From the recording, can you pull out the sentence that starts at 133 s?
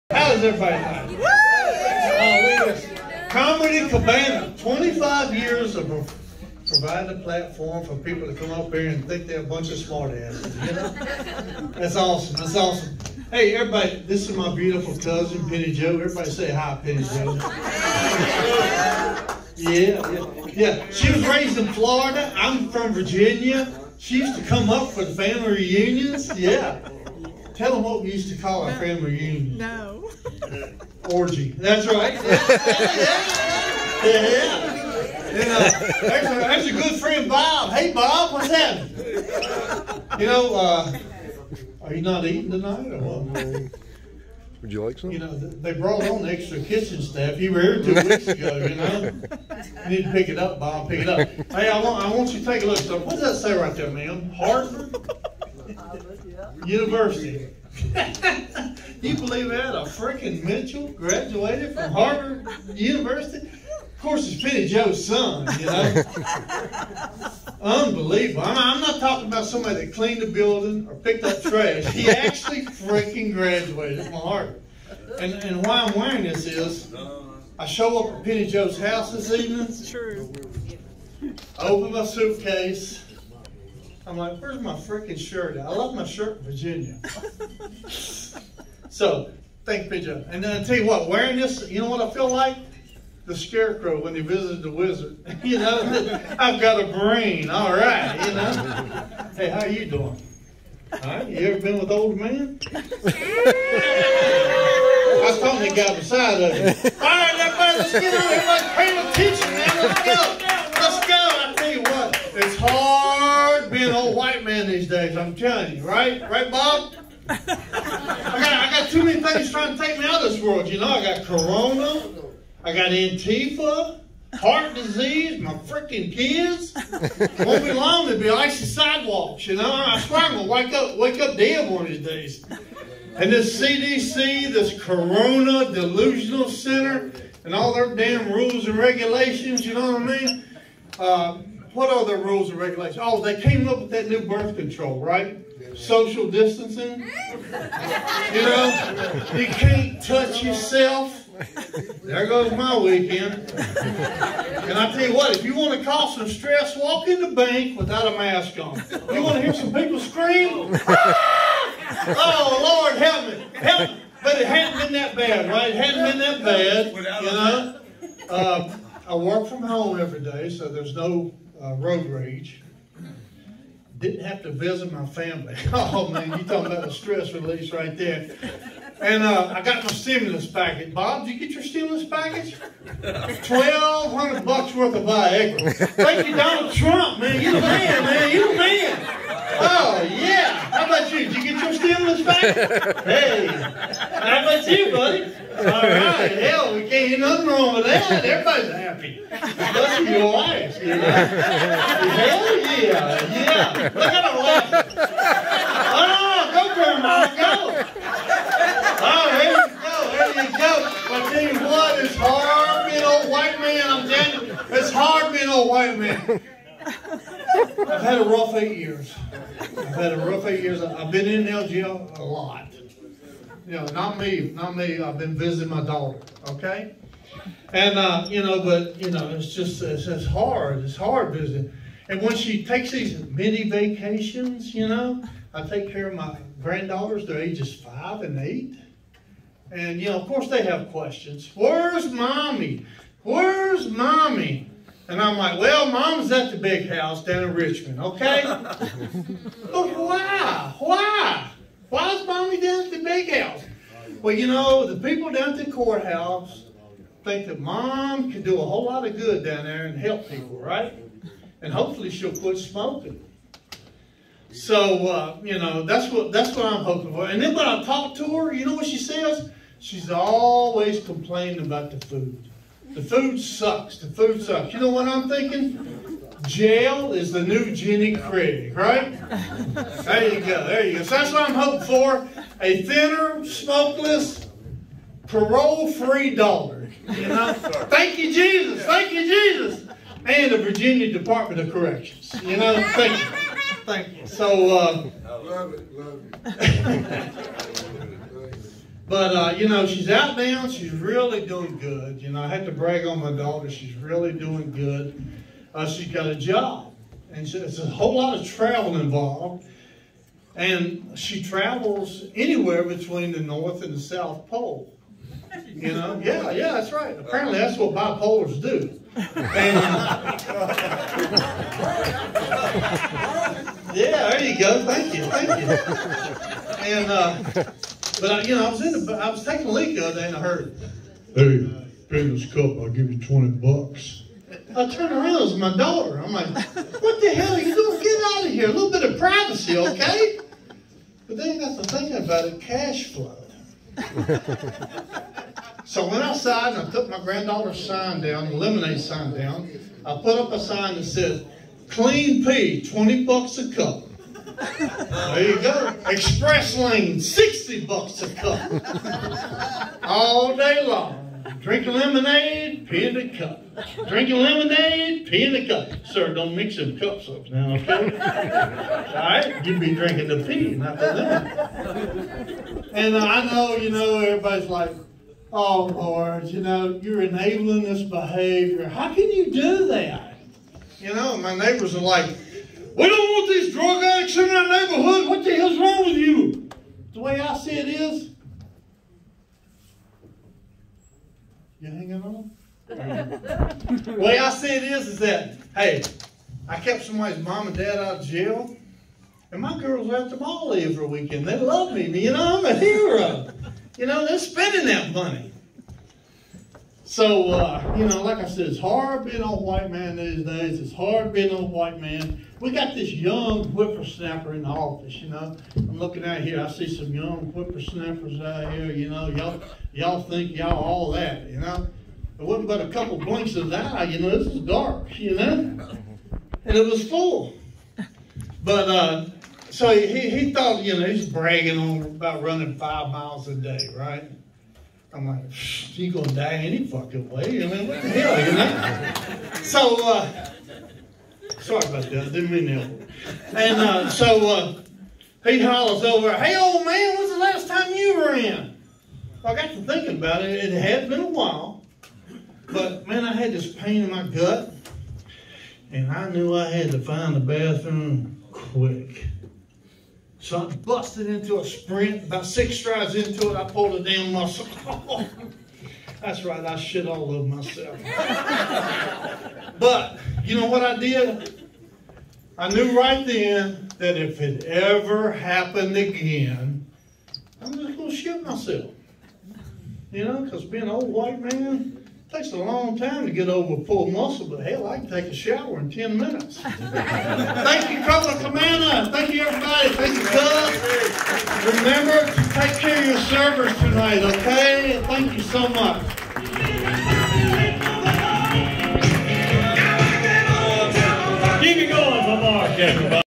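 And this CDC, this corona delusional center, and all their damn rules and regulations, you know what I mean?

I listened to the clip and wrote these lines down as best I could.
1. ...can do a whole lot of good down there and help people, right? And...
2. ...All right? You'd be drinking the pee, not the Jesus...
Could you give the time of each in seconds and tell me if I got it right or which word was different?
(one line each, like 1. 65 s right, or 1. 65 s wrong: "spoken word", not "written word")
1. 258 s right
2. 369 s wrong: "And", not "Jesus".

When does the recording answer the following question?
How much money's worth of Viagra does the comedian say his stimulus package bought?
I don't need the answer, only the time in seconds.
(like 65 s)
183 s.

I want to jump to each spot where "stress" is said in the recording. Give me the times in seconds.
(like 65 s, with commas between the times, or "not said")
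156 s, 176 s.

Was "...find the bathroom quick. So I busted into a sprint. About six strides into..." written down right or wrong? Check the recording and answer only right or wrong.
right.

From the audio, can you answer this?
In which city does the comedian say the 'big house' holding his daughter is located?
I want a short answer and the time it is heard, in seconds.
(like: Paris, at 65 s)
Richmond, at 247 s.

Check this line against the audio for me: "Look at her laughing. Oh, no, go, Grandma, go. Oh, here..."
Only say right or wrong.
right.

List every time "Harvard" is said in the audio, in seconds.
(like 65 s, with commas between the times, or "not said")
61 s, 74 s.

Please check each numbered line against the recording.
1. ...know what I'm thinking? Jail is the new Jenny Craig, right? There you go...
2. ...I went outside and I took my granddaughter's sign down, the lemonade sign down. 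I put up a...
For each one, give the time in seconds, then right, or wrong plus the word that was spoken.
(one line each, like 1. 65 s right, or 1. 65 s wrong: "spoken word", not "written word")
1. 274 s right
2. 346 s right.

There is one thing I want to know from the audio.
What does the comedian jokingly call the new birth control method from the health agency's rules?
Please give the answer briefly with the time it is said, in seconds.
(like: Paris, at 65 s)
Social distancing, at 145 s.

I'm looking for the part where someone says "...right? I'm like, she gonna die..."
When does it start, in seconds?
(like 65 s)
433 s.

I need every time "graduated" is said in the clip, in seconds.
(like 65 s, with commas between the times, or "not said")
60 s, 73 s.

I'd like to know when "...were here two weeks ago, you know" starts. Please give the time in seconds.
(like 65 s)
47 s.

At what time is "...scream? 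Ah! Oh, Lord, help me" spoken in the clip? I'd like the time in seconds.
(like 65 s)
159 s.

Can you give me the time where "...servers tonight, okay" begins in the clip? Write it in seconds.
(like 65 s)
493 s.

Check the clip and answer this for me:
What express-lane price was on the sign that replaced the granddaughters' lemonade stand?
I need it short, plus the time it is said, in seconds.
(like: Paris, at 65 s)
$60 a cup, at 357 s.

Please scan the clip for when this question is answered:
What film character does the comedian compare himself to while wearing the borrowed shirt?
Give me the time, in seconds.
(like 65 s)
93 s.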